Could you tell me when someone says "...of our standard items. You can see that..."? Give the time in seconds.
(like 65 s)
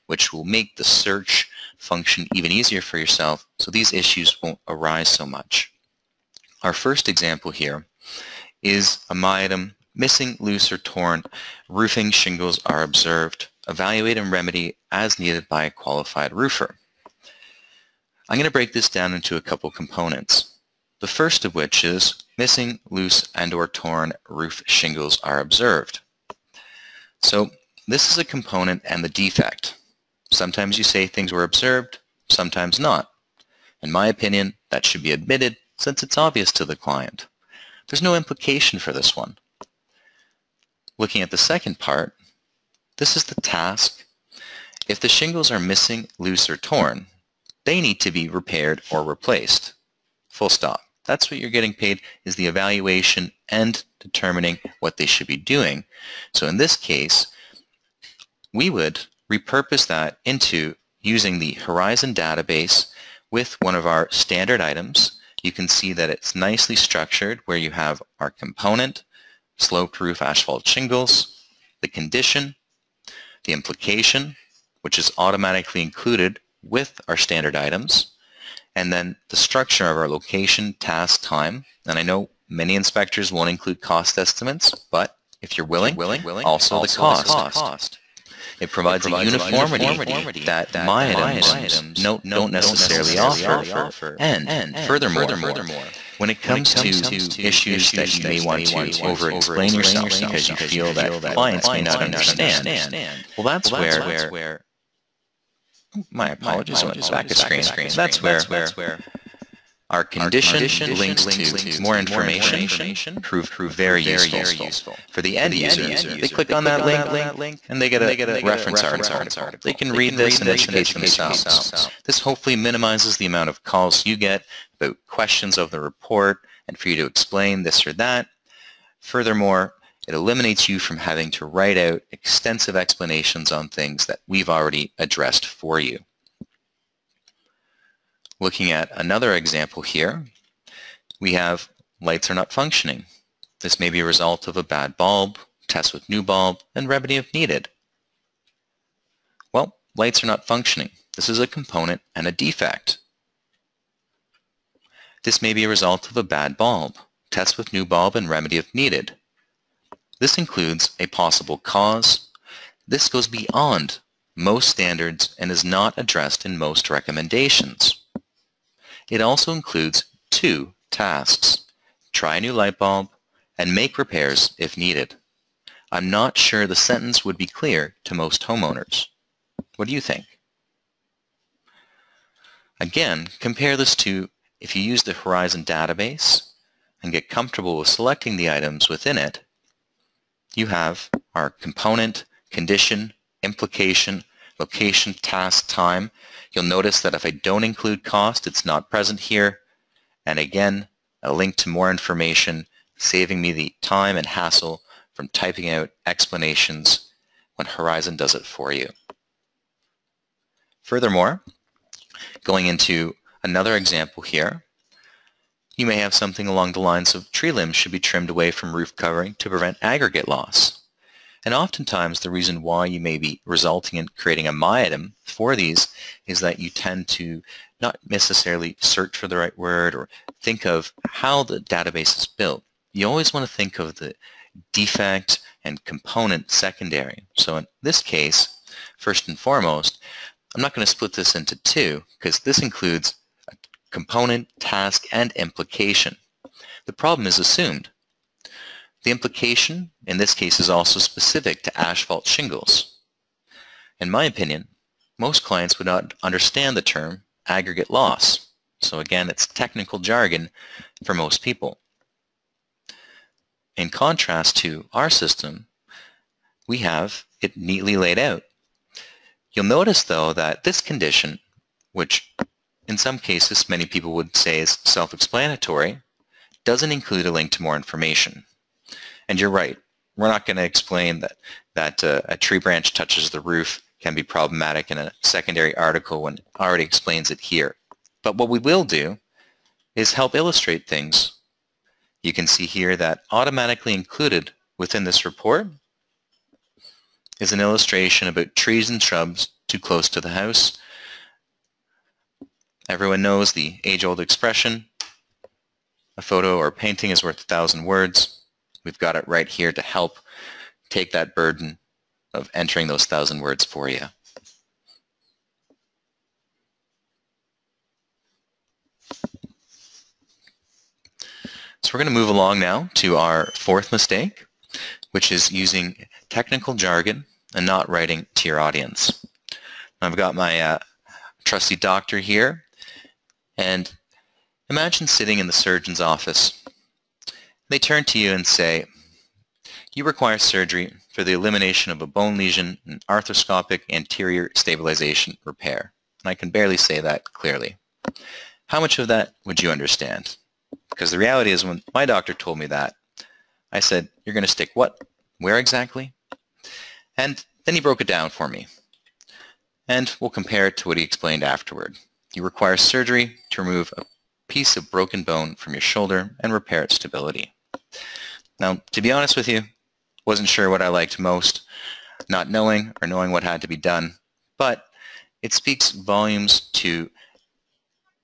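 63 s.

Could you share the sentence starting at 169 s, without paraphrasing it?
It also includes two tasks, try a new light bulb and make repairs if needed.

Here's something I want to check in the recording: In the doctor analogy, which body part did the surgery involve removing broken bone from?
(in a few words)
shoulder.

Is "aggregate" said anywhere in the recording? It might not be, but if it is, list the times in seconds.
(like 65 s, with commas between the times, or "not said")
219 s, 257 s.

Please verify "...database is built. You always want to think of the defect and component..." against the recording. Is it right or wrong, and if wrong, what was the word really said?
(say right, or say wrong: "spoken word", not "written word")
right.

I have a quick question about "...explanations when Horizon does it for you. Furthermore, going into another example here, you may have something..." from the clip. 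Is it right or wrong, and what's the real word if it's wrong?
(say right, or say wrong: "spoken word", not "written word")
right.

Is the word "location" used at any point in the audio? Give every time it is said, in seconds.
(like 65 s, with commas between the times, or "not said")
80 s, 194 s.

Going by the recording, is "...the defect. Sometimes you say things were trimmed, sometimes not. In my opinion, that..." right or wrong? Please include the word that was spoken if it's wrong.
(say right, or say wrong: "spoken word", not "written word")
wrong: "observed", not "trimmed".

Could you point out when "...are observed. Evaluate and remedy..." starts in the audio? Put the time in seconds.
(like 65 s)
12 s.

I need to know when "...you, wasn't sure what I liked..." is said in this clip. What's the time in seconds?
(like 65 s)
369 s.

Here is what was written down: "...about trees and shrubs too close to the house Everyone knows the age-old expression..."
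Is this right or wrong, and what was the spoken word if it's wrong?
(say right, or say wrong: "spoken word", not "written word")
right.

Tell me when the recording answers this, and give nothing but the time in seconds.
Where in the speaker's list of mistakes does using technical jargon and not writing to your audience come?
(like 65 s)
323 s.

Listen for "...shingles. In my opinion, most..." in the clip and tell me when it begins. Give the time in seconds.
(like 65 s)
252 s.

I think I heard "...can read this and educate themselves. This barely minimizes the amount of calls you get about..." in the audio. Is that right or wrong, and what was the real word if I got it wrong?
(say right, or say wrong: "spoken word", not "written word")
wrong: "hopefully", not "barely".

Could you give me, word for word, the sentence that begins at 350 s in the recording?
Because the reality is when my doctor told me that, I said, you're going to stick what?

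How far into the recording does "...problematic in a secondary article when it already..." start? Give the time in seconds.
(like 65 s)
284 s.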